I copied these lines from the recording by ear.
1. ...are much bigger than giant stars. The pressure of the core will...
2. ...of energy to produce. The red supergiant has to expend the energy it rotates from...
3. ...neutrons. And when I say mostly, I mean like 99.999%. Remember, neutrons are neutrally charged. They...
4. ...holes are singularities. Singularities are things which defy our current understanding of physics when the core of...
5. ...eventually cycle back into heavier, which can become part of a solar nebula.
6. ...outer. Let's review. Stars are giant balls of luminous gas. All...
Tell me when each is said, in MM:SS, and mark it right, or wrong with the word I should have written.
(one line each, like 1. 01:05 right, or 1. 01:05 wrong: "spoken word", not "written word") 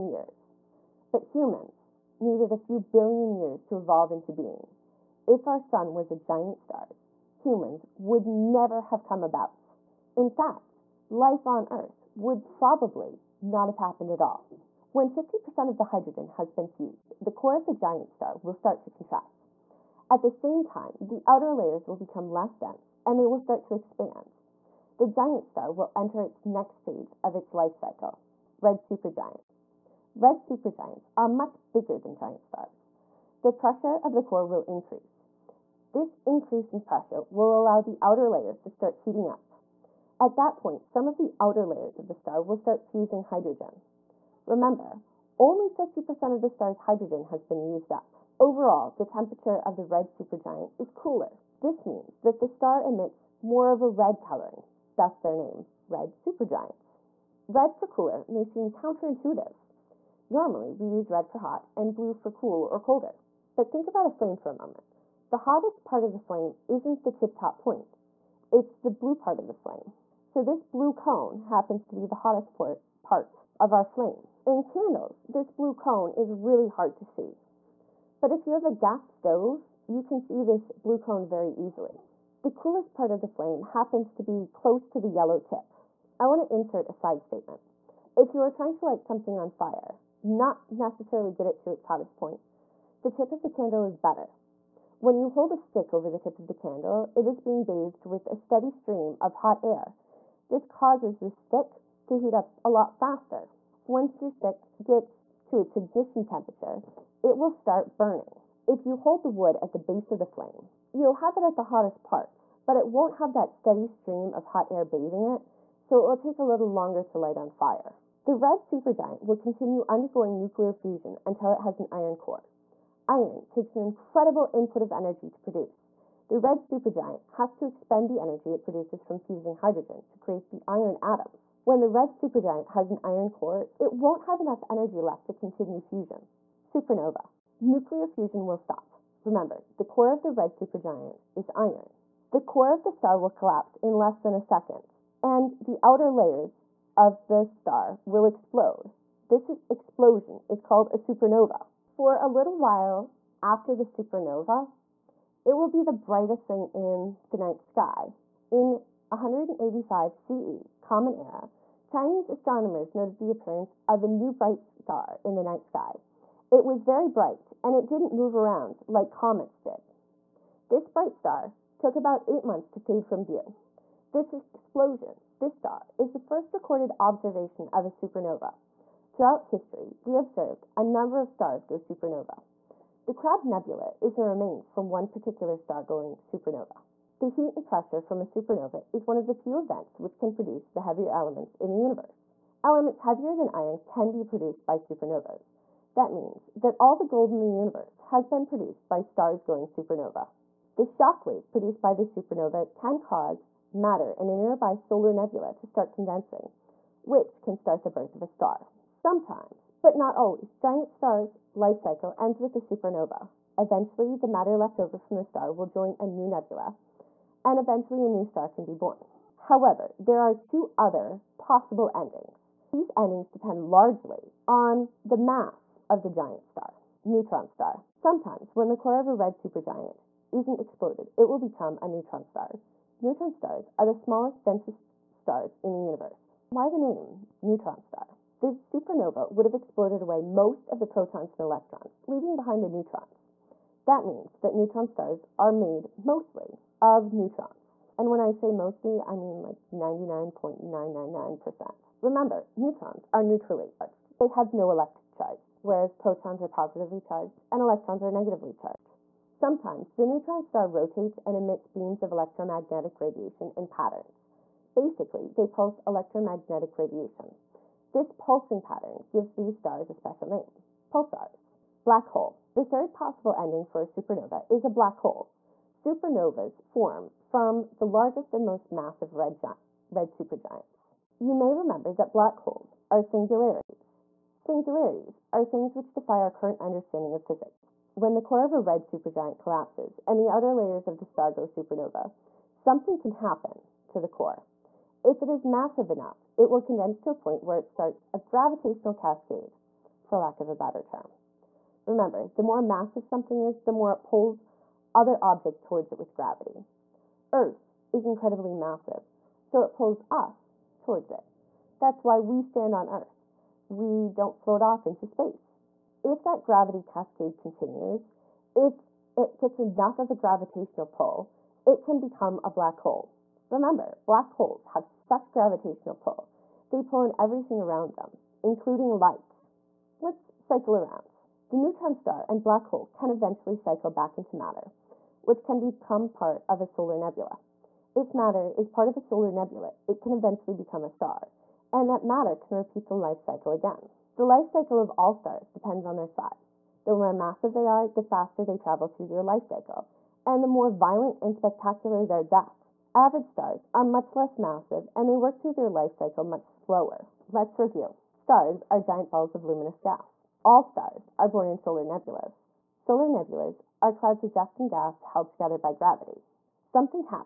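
1. 00:31 right
2. 02:04 wrong: "produces", not "rotates"
3. 04:07 right
4. 04:42 right
5. 05:33 wrong: "matter", not "heavier"
6. 05:56 wrong: "slower", not "outer".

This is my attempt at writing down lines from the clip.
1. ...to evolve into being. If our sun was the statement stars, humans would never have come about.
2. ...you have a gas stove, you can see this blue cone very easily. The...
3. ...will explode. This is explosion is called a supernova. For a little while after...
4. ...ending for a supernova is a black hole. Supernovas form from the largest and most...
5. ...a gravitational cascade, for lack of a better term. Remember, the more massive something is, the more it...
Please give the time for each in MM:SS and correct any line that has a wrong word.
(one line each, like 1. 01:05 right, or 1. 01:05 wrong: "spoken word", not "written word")
1. 00:03 wrong: "giant", not "statement"
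2. 01:18 right
3. 02:28 right
4. 04:33 right
5. 04:58 right.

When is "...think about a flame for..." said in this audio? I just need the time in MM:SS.
01:03.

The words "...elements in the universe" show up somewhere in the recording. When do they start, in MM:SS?
03:11.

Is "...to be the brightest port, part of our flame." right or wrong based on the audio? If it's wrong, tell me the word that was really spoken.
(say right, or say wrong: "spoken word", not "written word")
wrong: "hottest", not "brightest".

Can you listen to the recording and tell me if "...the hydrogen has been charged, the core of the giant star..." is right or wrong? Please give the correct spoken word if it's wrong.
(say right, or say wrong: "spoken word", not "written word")
wrong: "fused", not "charged".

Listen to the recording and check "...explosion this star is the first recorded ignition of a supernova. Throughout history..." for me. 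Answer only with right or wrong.
wrong.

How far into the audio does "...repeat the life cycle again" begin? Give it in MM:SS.
05:42.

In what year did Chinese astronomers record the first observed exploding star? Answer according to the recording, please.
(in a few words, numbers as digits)
185 CE.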